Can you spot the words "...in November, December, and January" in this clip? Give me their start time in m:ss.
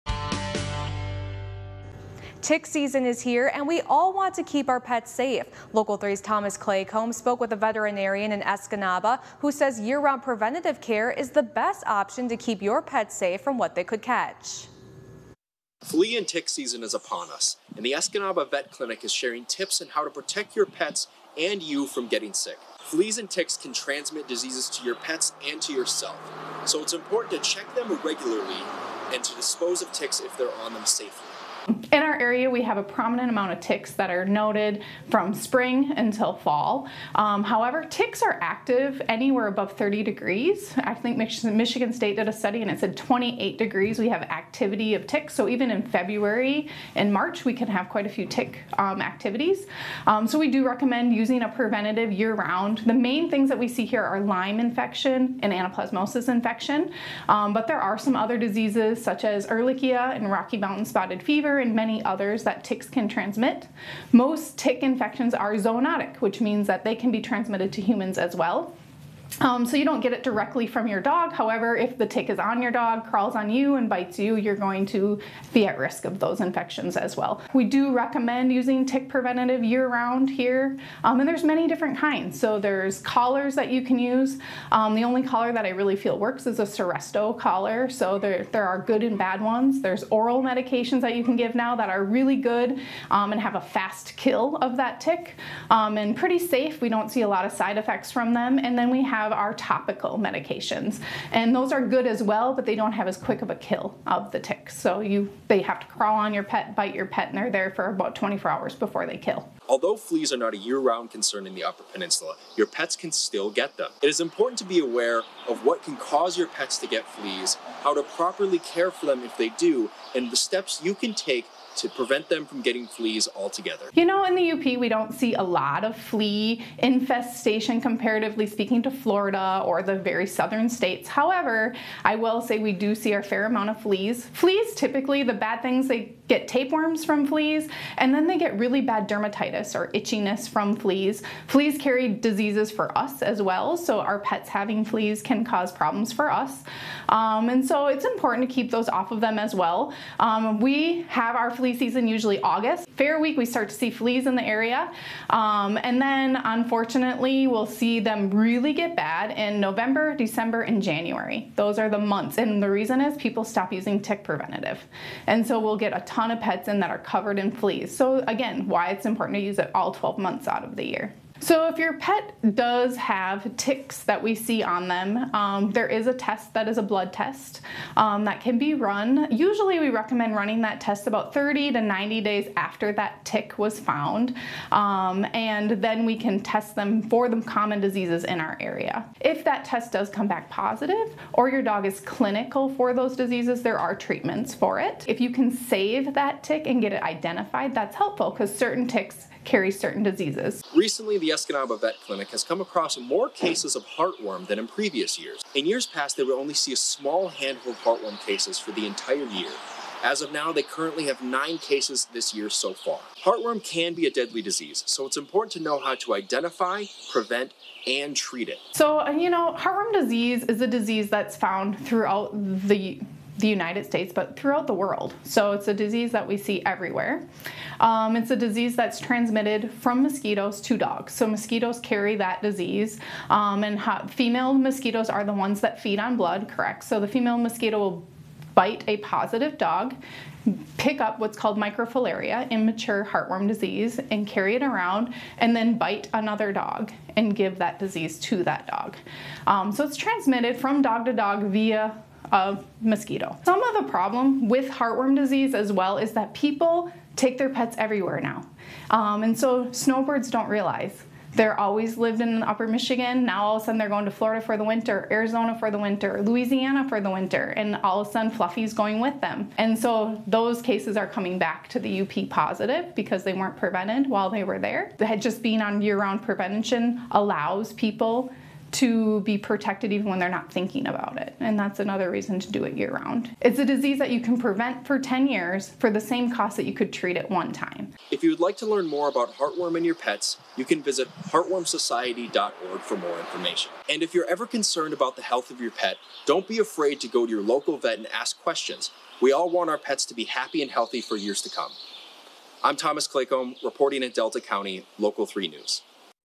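2:39.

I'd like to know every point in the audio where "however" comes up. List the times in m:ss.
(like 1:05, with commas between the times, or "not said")
0:37, 1:11, 2:11.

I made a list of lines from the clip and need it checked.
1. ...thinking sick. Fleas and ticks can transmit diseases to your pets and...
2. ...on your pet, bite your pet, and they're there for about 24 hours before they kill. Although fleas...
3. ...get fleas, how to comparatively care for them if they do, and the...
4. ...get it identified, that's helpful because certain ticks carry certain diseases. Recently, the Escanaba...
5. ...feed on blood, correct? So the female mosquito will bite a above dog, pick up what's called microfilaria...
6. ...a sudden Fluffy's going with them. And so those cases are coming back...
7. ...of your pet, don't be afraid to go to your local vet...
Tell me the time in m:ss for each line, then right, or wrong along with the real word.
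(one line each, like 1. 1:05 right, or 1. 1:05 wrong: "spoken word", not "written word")
1. 0:22 wrong: "getting", not "thinking"
2. 1:46 right
3. 1:56 wrong: "properly", not "comparatively"
4. 3:16 right
5. 3:55 wrong: "positive", not "above"
6. 4:28 right
7. 4:55 right.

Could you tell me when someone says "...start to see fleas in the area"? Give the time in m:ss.
2:33.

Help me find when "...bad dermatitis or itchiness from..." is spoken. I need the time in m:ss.
2:18.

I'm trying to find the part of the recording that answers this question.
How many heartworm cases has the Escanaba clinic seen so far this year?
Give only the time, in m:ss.
3:31.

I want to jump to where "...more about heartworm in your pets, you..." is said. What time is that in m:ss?
4:48.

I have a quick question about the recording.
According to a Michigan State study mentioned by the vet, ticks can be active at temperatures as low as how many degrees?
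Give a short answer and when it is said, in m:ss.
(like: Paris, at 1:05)
28, at 0:42.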